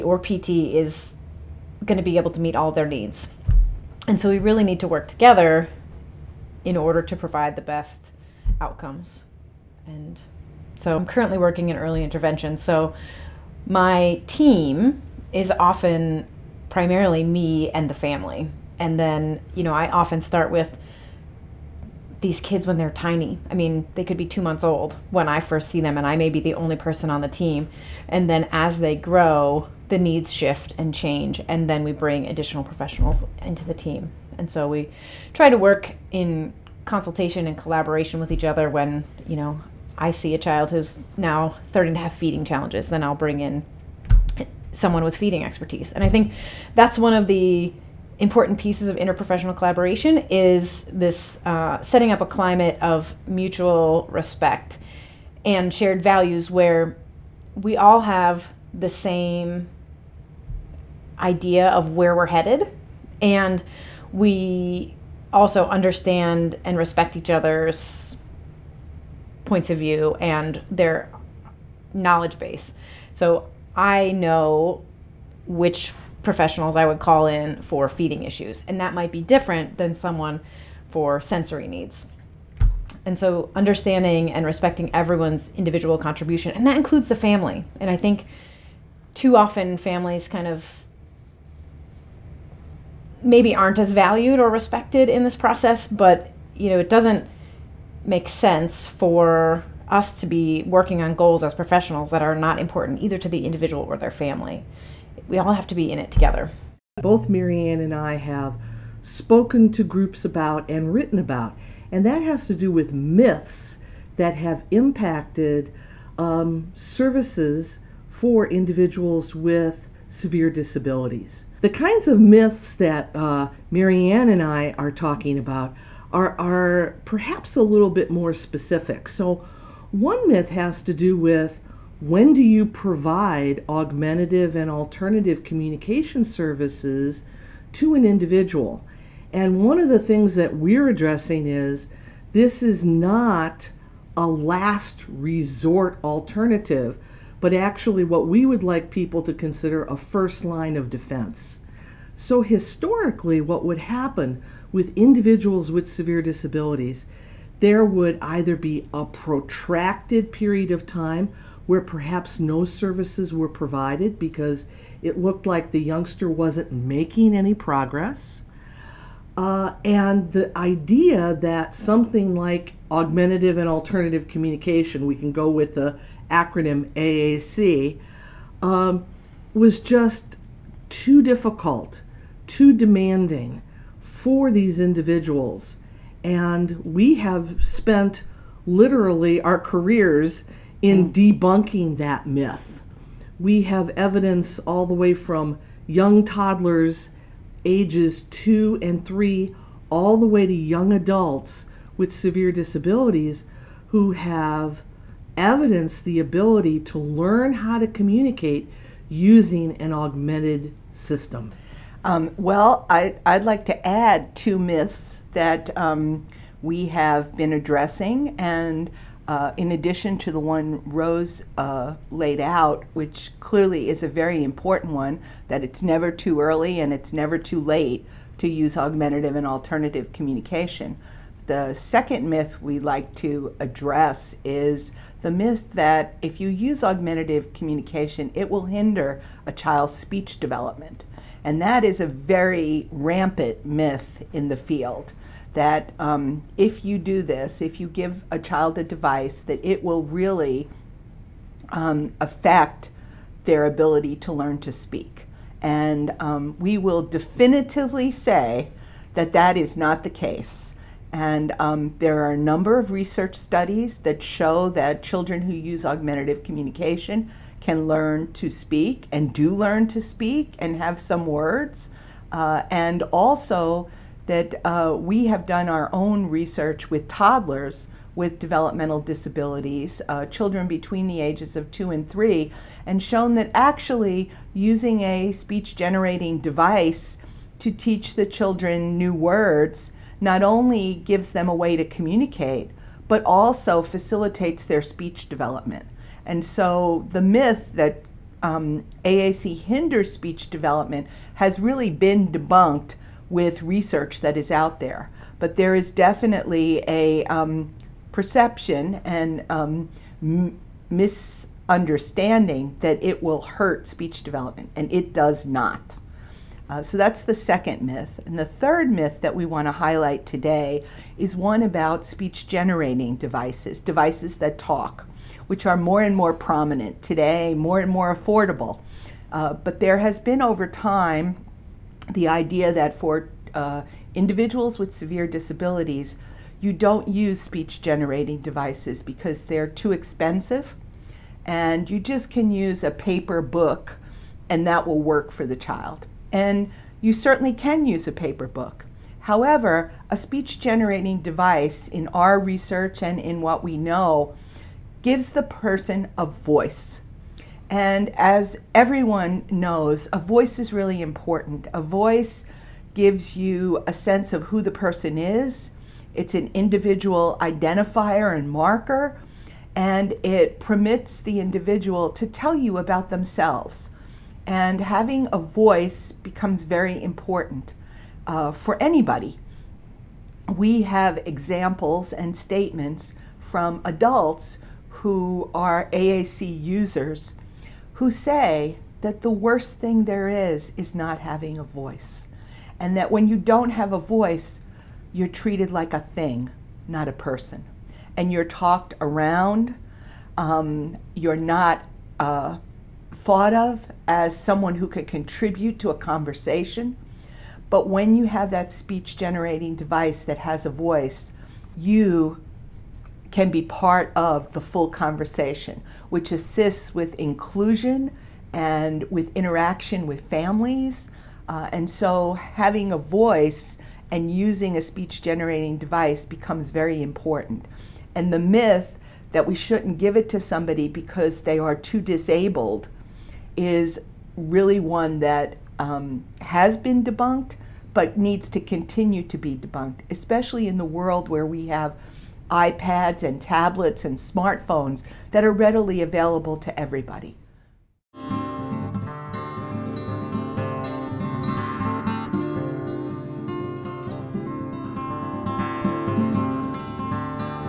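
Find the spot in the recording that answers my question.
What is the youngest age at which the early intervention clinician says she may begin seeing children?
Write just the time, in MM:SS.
00:24.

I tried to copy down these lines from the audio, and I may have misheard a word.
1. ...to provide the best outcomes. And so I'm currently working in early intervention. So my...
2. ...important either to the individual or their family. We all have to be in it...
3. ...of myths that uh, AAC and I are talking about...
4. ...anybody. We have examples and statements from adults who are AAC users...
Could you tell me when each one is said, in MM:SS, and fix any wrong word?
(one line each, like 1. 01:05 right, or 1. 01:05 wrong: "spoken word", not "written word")
1. 00:07 right
2. 01:42 right
3. 02:02 wrong: "Marianne", not "AAC"
4. 06:18 right.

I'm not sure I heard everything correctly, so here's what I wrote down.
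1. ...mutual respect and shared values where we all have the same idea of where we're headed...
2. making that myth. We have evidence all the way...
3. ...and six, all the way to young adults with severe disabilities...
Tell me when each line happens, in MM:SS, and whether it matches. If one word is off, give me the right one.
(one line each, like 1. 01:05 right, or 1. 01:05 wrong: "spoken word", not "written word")
1. 00:53 right
2. 03:11 wrong: "debunking", not "making"
3. 03:18 wrong: "three", not "six".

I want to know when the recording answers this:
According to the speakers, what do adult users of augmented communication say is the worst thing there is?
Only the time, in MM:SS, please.
06:30.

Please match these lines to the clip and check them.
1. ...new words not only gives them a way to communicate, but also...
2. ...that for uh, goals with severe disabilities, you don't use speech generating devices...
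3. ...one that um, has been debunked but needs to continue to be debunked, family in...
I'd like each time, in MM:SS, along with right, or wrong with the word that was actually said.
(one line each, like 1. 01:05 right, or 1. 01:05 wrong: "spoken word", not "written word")
1. 04:48 right
2. 05:32 wrong: "individuals", not "goals"
3. 07:14 wrong: "especially", not "family".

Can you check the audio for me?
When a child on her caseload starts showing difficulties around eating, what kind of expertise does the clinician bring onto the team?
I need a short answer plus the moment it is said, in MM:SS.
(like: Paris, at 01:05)
feeding expertise, at 00:45.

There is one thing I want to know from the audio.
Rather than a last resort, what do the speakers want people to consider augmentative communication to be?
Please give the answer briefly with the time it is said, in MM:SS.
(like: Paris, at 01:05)
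a first line of defense, at 02:29.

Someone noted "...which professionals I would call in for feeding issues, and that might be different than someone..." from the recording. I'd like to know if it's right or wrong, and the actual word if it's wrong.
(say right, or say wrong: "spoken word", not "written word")
right.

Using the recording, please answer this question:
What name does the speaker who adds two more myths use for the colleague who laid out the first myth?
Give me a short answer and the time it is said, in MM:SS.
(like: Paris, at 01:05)
Rose, at 03:40.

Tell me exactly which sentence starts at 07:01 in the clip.
Uh, and so having a voice and using a speech generating device becomes very important.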